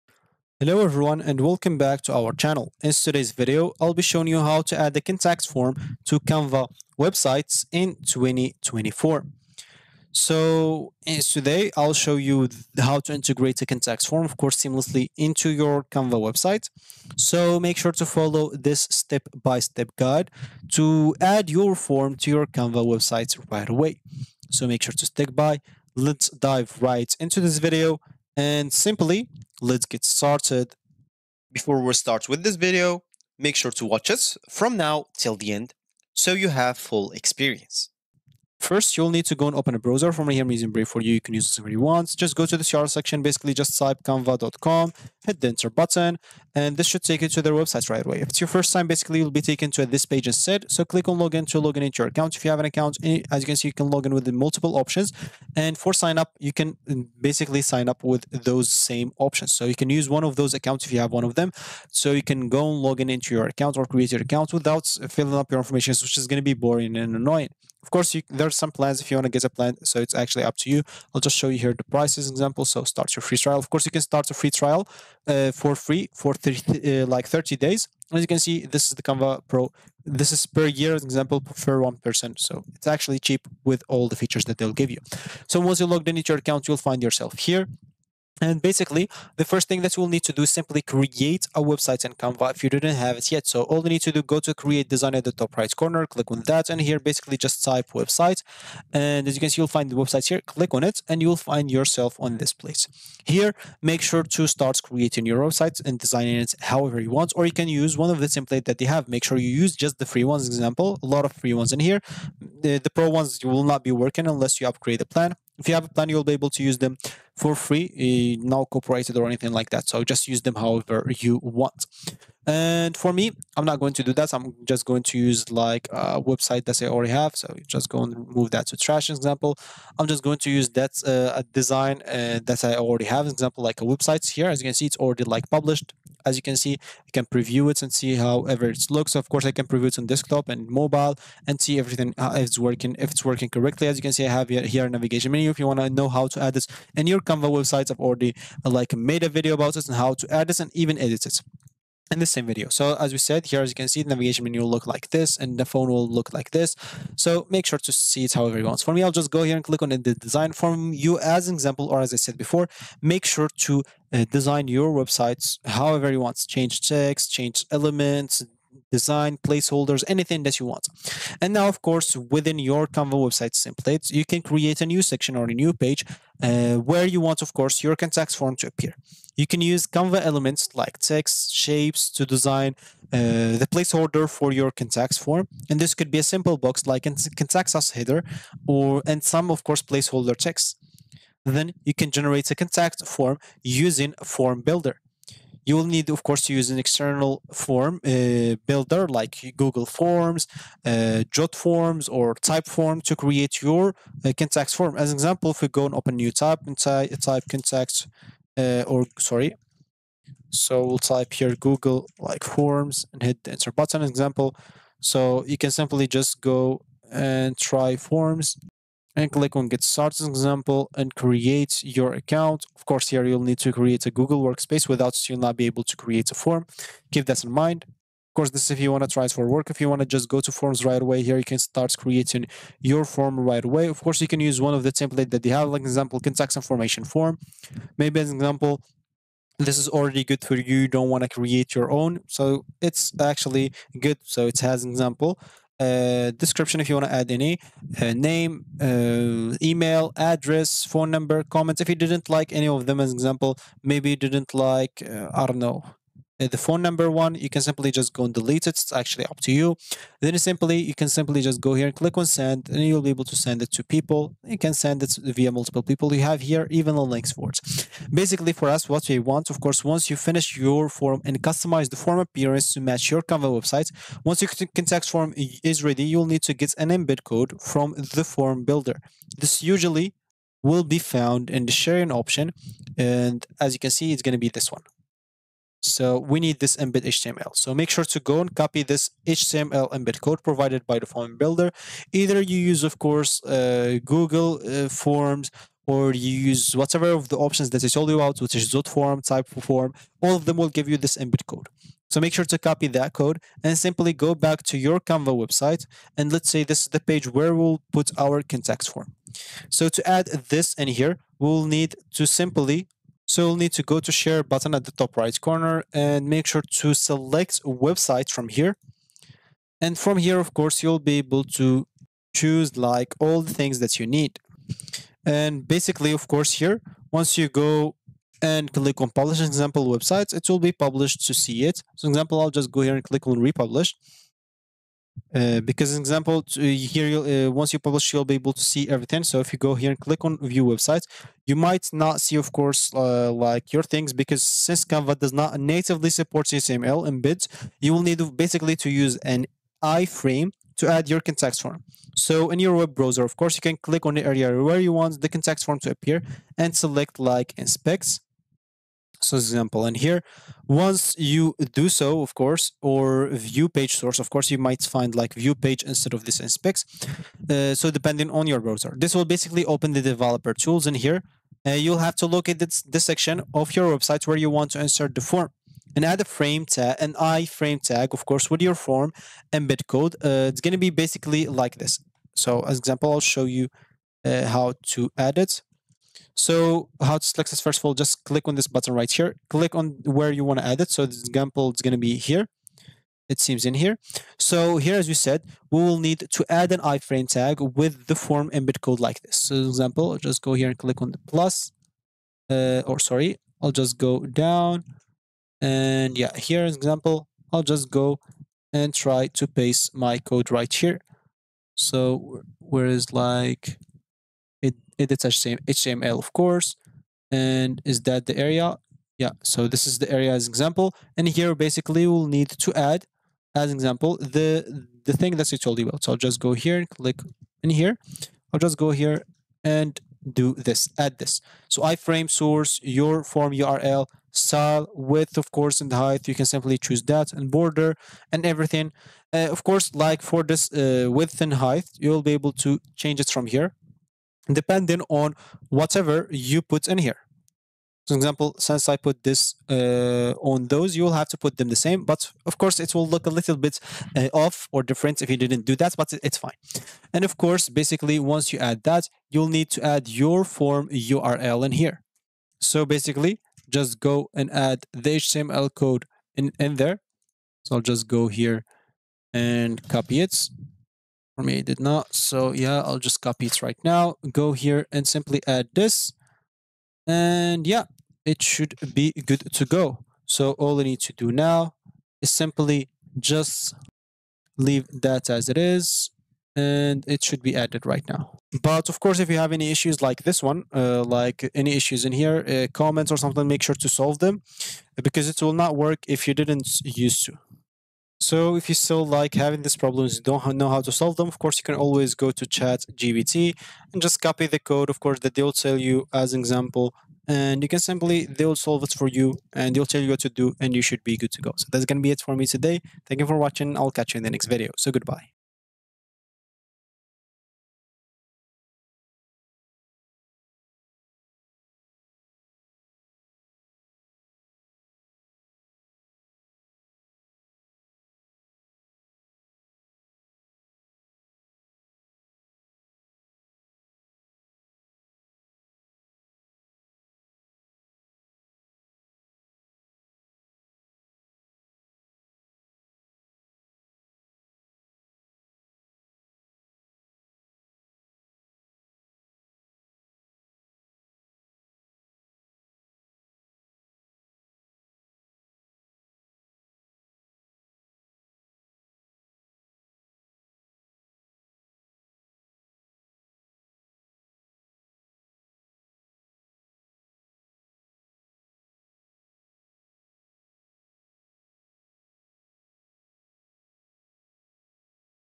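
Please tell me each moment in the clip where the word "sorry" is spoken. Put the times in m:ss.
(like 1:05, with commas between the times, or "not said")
3:29, 6:42.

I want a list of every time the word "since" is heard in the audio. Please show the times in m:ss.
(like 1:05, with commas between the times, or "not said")
5:44, 7:28.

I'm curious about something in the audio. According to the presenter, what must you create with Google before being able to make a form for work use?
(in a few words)
Google Workspace.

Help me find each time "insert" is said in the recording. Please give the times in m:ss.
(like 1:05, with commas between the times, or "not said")
6:14.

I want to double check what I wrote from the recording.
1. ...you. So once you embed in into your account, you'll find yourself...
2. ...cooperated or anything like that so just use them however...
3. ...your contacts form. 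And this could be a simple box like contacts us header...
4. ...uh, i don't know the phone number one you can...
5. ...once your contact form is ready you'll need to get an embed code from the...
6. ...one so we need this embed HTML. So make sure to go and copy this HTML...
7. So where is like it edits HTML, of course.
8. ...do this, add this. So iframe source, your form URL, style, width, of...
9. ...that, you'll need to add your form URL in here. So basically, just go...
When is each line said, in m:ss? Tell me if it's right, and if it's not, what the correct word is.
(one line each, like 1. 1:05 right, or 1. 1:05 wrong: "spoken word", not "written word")
1. 1:24 wrong: "logged", not "embed"
2. 1:58 right
3. 3:04 right
4. 4:15 right
5. 4:34 right
6. 4:44 right
7. 6:51 right
8. 7:10 right
9. 7:38 right.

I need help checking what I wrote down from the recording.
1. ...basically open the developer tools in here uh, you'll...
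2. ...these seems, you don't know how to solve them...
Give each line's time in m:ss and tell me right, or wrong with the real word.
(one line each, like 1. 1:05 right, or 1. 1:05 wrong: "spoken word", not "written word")
1. 6:09 right
2. 8:19 wrong: "problems", not "seems".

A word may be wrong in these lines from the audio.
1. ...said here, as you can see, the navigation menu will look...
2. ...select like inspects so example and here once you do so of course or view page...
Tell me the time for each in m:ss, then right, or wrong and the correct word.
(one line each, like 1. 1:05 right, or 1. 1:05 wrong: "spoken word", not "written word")
1. 2:33 right
2. 5:56 right.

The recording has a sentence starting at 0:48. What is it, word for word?
If it's your first time, basically, you'll be taken to this page instead.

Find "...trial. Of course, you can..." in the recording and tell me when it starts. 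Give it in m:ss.
1:13.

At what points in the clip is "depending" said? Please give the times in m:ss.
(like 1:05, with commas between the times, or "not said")
6:07, 7:24.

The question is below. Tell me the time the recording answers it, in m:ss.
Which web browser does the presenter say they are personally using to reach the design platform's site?
0:40.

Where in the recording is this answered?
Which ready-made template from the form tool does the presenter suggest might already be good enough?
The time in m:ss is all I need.
3:56.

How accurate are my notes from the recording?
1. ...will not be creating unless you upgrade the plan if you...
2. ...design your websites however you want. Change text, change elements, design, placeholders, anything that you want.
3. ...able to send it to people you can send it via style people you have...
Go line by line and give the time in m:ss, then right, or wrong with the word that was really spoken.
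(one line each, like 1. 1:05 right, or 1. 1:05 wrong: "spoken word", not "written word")
1. 1:53 wrong: "working", not "creating"
2. 2:44 right
3. 4:23 wrong: "multiple", not "style".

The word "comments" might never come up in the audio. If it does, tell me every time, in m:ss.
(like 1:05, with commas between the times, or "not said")
4:11, 8:12.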